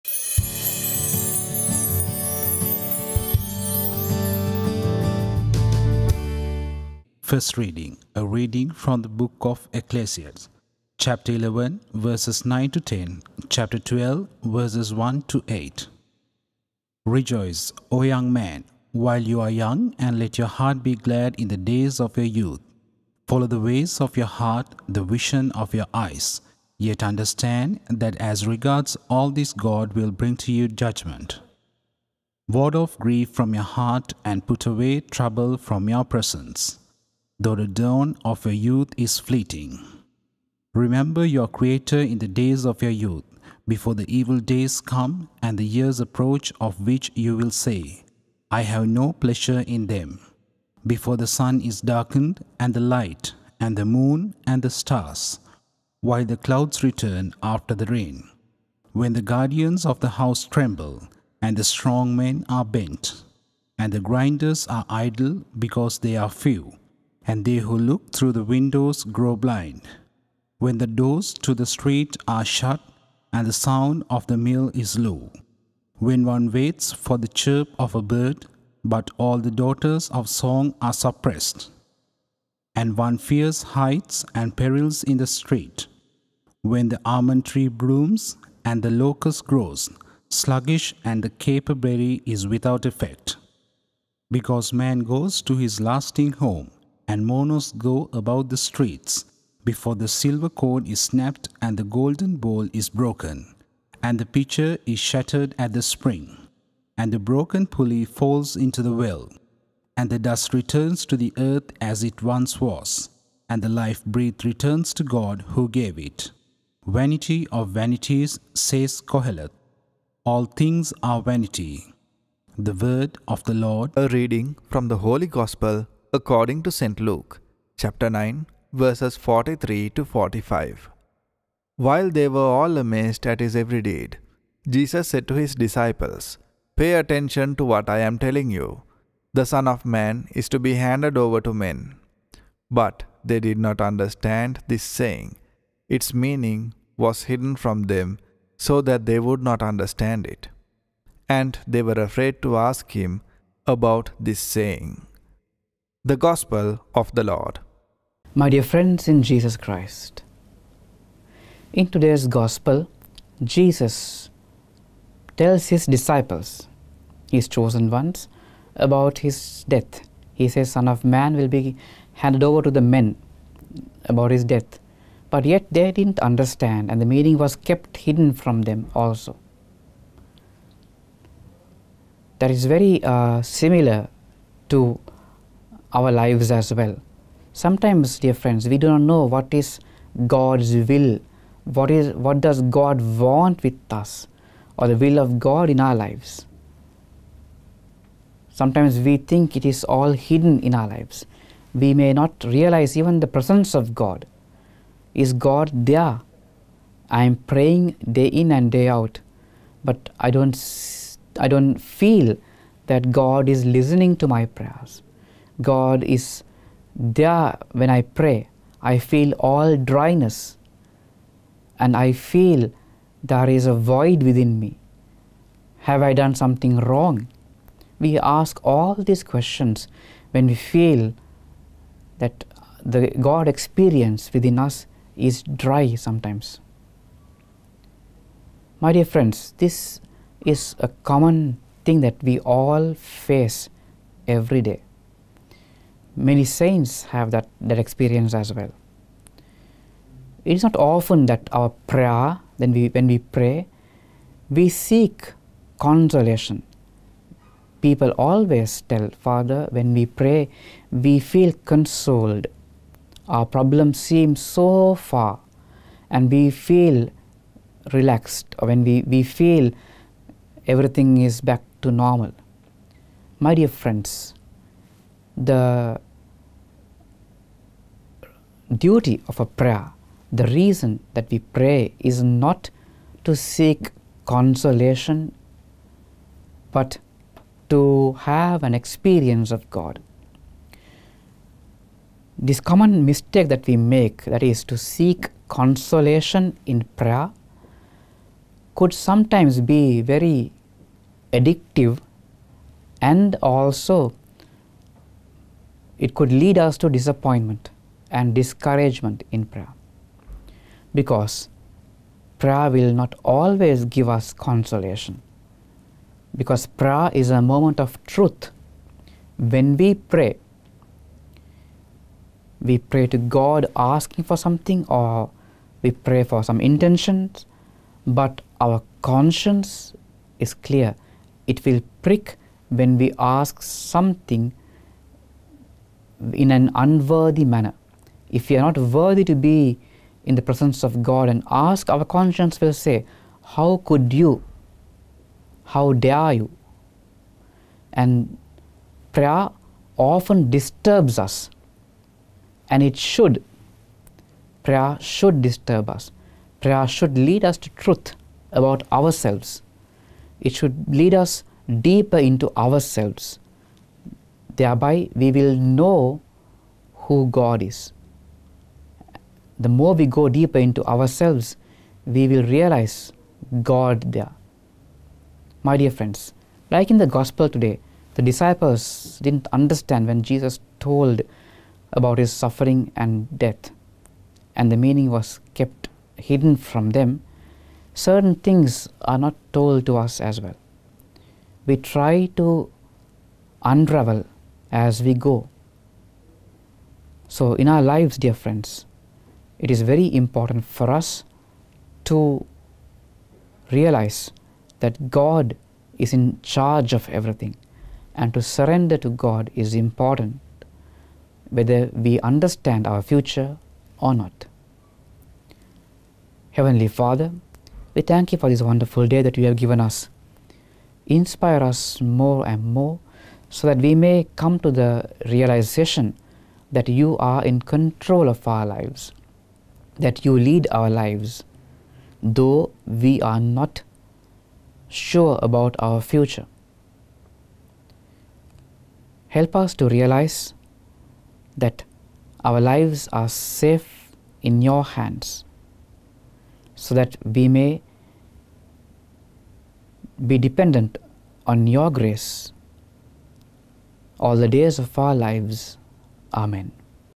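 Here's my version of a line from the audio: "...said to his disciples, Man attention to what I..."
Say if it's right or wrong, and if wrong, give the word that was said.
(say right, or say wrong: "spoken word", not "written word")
wrong: "Pay", not "Man".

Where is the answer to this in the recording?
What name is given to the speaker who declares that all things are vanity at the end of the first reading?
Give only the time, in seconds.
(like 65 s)
119 s.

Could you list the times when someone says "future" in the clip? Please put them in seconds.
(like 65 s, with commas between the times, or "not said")
413 s, 435 s.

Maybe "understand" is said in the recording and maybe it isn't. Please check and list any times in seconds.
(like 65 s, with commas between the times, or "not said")
27 s, 143 s, 149 s, 176 s, 379 s, 412 s.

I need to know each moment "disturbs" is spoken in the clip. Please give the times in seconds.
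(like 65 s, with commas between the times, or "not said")
350 s, 355 s.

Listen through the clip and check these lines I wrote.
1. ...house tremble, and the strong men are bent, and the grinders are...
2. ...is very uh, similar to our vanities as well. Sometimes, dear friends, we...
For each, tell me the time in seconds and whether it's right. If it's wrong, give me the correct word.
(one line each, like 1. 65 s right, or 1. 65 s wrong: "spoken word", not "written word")
1. 60 s right
2. 182 s wrong: "lives", not "vanities".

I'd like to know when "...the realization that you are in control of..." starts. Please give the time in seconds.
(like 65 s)
424 s.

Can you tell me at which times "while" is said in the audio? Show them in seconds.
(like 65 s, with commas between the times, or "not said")
18 s, 56 s, 131 s.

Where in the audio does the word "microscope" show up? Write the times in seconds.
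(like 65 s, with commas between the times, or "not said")
not said.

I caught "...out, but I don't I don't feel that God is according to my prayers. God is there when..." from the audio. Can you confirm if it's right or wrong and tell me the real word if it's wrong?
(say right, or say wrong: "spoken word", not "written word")
wrong: "listening", not "according".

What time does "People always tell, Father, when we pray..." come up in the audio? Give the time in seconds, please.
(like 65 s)
257 s.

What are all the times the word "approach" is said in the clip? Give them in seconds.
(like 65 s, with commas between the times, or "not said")
45 s.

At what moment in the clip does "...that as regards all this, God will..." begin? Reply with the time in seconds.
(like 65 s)
27 s.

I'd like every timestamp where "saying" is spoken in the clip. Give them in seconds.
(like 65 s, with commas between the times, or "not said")
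144 s, 154 s.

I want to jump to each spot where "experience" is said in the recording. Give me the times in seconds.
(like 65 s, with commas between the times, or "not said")
233 s, 247 s, 288 s.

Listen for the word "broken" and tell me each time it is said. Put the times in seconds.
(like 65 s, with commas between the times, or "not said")
102 s, 107 s.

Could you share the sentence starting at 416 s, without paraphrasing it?
Heavenly Father, we thank you for this wonderful day that you have given us.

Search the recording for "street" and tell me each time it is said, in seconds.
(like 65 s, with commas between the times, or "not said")
71 s, 85 s, 98 s.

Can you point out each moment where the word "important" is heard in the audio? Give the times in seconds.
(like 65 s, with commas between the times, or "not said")
400 s, 409 s.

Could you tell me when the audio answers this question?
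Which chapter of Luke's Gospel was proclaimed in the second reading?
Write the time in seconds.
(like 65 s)
127 s.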